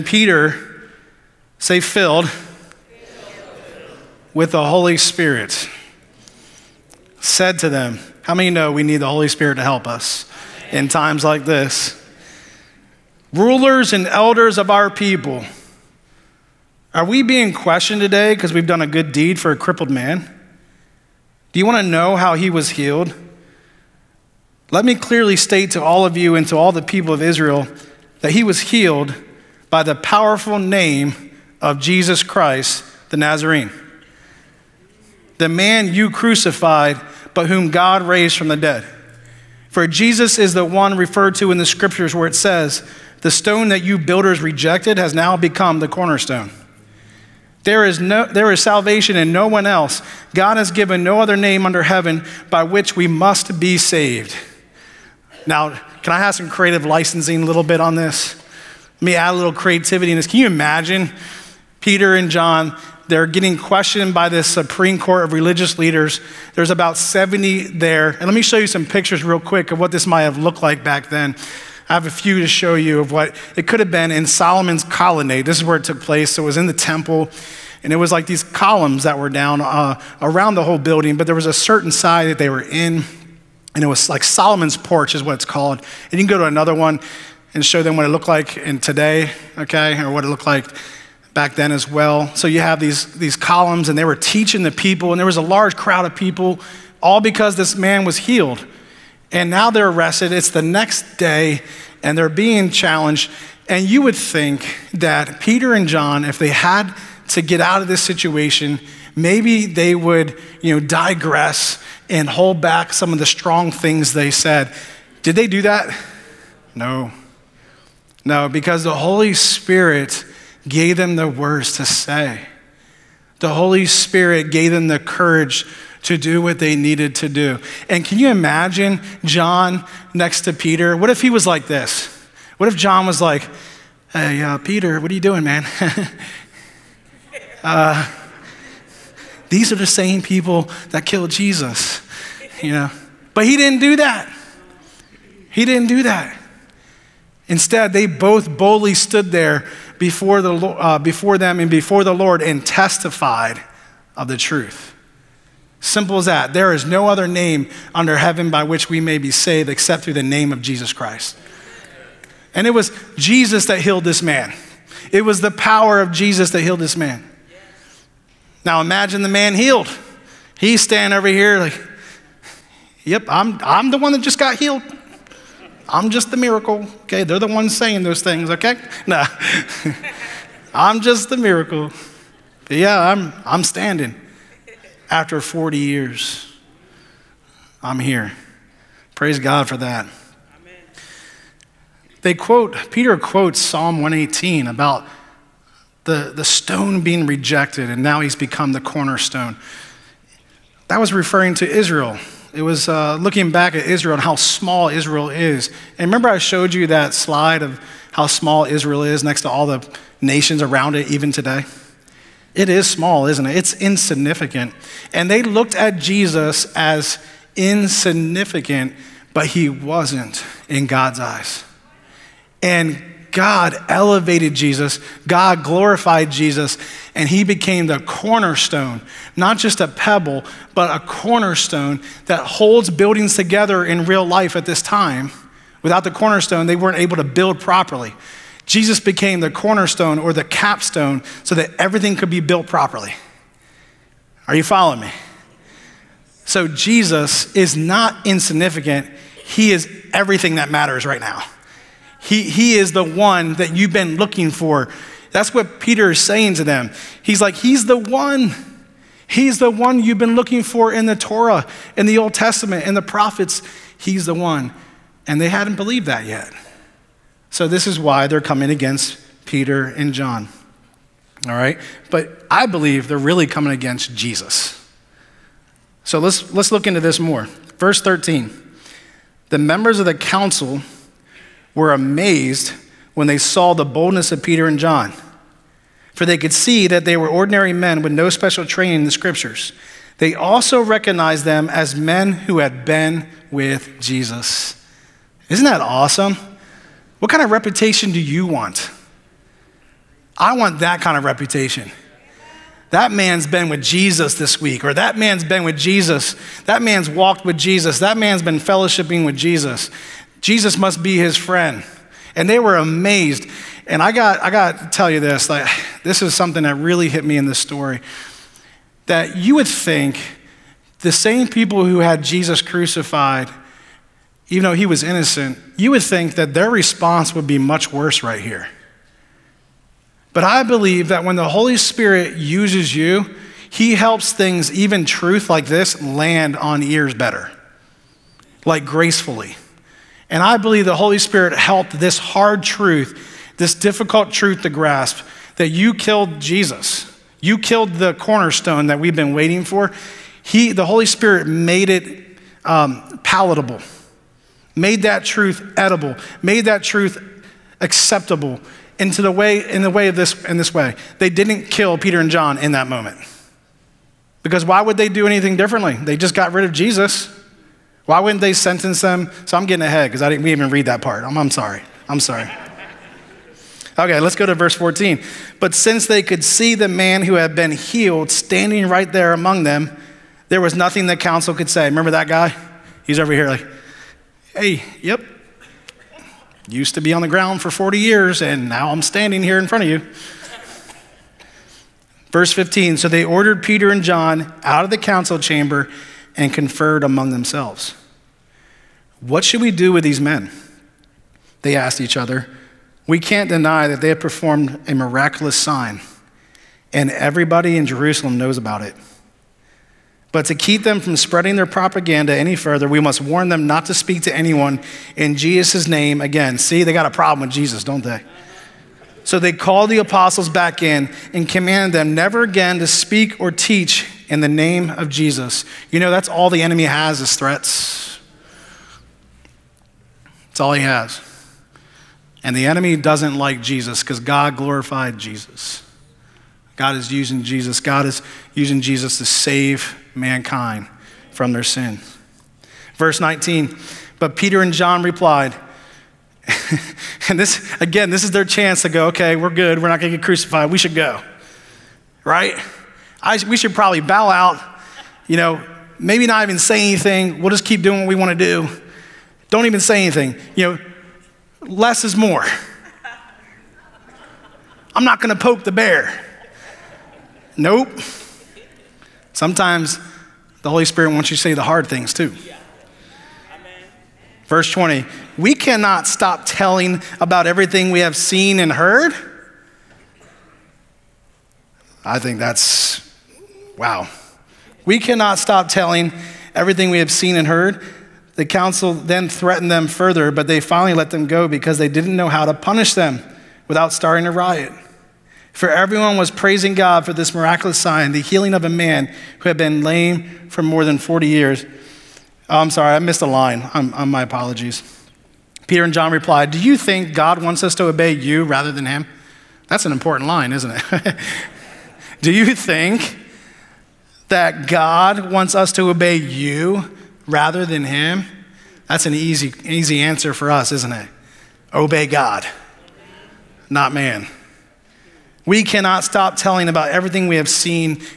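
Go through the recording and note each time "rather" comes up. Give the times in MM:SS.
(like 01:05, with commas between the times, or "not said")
08:28, 08:37.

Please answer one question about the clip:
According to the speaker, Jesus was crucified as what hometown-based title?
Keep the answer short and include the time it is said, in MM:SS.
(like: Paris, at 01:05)
the Nazarene, at 00:33.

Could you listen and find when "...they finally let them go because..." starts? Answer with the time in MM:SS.
08:10.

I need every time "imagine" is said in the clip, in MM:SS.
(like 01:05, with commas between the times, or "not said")
01:00, 02:08, 02:48.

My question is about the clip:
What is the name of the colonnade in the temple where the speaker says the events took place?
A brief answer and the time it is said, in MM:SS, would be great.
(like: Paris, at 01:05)
Solomon's colonnade, at 01:14.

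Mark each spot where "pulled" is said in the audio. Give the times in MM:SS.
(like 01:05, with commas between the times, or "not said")
not said.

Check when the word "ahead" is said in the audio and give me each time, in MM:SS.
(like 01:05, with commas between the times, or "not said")
06:09.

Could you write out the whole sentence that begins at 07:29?
We're not going to get crucified.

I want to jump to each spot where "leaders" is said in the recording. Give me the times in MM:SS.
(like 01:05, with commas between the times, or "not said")
01:05.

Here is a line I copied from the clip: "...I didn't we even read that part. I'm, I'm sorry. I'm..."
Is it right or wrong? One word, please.
right.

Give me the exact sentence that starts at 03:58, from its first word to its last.
Jesus became the cornerstone or the capstone so that everything could be built properly.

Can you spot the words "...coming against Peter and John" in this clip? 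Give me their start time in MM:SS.
04:28.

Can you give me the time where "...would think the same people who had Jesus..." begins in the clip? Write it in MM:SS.
05:19.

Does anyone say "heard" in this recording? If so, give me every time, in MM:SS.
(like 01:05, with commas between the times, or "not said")
07:58, 08:07.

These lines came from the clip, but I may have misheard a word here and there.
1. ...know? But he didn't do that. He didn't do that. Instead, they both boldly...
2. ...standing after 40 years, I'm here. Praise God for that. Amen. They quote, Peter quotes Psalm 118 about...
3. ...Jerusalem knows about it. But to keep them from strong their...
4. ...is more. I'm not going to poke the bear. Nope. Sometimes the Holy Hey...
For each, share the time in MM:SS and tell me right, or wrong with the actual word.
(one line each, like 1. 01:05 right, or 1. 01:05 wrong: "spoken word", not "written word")
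1. 02:22 right
2. 03:03 right
3. 06:47 wrong: "spreading", not "strong"
4. 07:42 wrong: "Spirit", not "Hey".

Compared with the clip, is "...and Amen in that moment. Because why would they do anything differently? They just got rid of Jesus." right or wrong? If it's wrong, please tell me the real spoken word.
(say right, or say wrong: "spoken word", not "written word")
wrong: "John", not "Amen".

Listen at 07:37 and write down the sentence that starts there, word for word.
We'll just keep doing what we want to do.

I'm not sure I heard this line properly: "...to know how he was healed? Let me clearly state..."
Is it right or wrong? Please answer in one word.
right.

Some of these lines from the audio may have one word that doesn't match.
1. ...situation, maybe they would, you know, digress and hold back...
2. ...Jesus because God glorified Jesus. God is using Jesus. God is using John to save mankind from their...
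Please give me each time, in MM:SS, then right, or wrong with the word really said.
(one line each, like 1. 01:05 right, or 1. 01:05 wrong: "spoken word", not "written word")
1. 01:48 right
2. 07:13 wrong: "Jesus", not "John".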